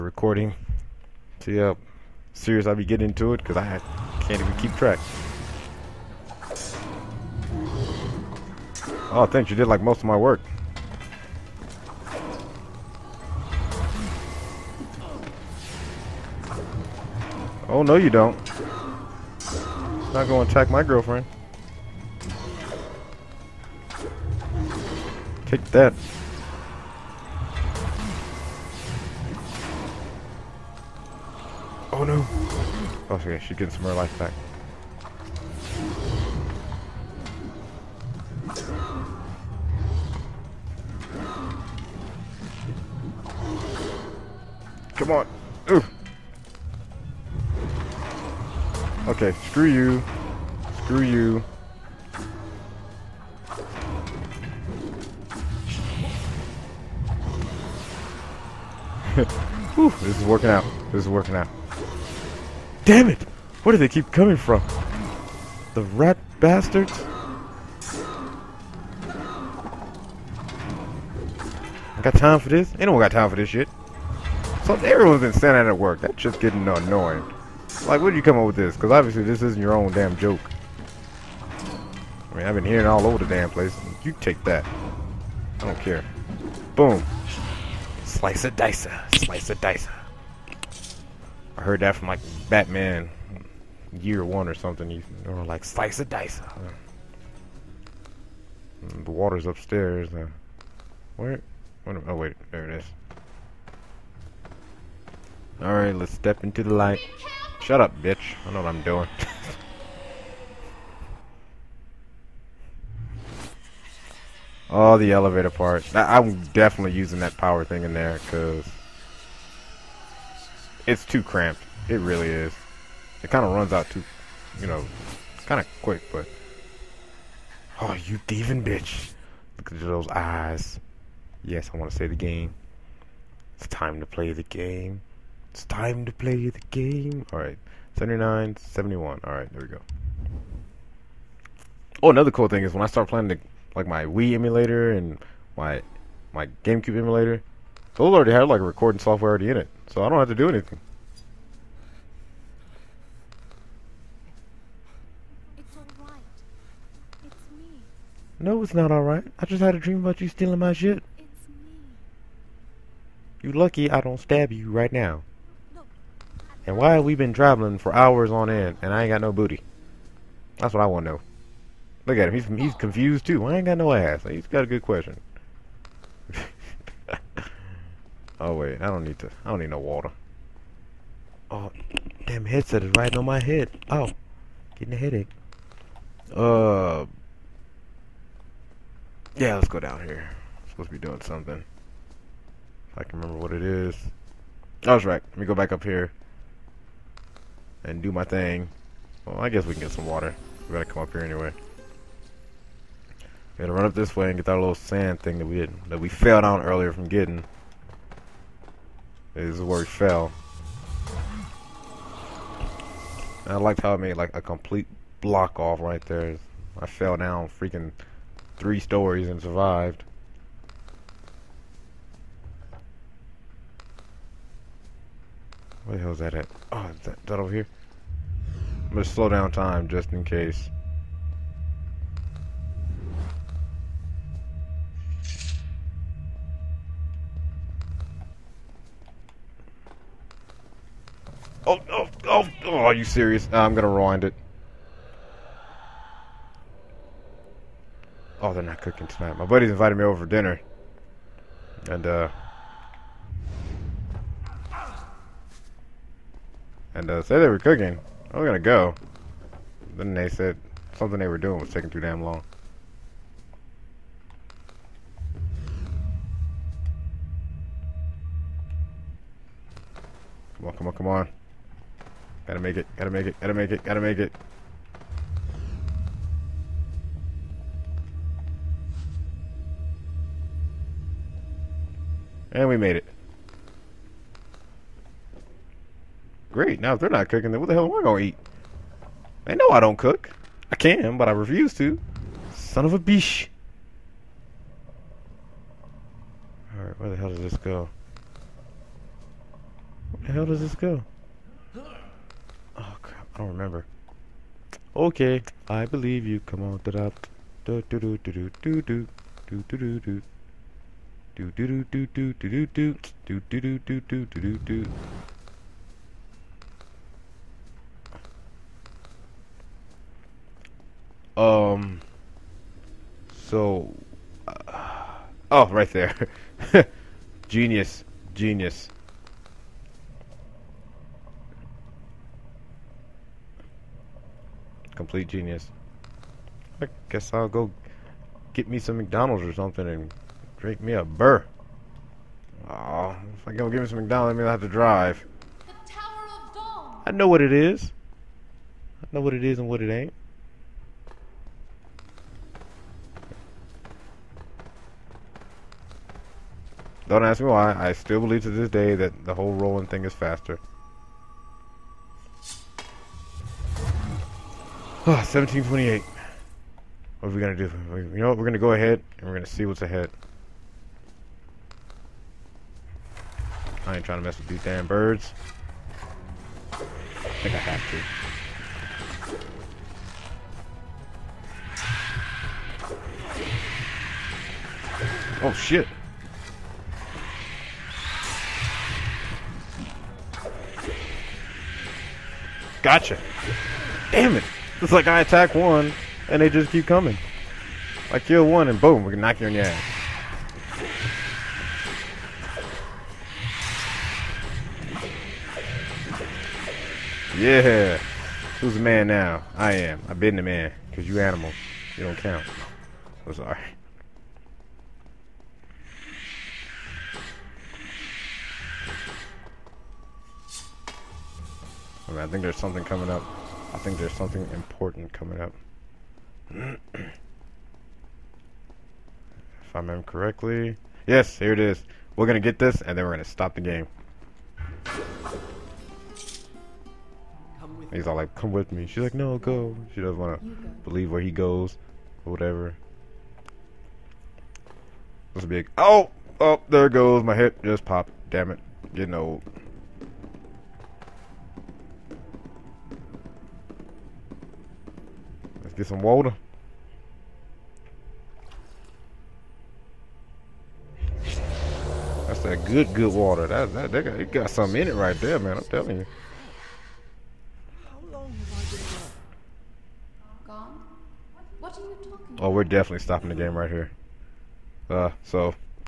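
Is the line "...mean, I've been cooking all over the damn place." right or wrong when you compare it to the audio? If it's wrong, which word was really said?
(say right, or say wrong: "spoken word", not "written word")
wrong: "hearing", not "cooking".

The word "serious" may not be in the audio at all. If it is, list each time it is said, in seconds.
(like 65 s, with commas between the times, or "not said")
2 s, 243 s.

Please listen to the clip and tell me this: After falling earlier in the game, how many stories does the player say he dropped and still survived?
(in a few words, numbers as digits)
3.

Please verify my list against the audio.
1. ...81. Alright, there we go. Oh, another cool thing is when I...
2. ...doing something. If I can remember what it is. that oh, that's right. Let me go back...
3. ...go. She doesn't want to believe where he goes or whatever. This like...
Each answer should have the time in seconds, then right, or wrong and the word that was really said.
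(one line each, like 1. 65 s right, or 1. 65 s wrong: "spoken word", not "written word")
1. 138 s wrong: "71", not "81"
2. 191 s right
3. 439 s right.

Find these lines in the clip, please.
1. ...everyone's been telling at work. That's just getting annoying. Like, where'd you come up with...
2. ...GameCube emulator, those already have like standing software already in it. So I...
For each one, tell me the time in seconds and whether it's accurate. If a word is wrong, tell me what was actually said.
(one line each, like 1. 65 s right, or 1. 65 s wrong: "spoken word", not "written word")
1. 74 s wrong: "standing", not "telling"
2. 146 s wrong: "recording", not "standing".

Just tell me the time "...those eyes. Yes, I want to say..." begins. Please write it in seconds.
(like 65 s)
129 s.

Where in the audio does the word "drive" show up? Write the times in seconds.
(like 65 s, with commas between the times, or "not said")
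344 s.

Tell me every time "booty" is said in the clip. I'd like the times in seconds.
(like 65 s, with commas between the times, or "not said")
169 s.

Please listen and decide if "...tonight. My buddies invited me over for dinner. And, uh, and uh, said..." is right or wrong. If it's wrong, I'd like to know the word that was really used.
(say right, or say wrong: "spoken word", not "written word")
right.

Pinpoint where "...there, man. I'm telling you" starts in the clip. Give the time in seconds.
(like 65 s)
465 s.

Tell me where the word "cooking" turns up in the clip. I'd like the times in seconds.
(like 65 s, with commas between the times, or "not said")
248 s, 257 s.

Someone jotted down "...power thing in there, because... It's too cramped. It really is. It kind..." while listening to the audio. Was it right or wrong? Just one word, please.
right.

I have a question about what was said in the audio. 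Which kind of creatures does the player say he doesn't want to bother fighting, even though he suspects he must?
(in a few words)
birds.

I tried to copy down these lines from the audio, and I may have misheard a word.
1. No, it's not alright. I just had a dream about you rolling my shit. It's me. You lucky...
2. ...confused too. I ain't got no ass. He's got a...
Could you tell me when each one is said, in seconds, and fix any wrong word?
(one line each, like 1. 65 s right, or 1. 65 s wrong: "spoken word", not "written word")
1. 158 s wrong: "stealing", not "rolling"
2. 172 s right.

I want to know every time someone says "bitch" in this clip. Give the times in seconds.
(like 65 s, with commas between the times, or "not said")
108 s, 128 s.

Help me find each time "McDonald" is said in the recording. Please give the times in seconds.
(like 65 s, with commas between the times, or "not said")
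338 s, 343 s.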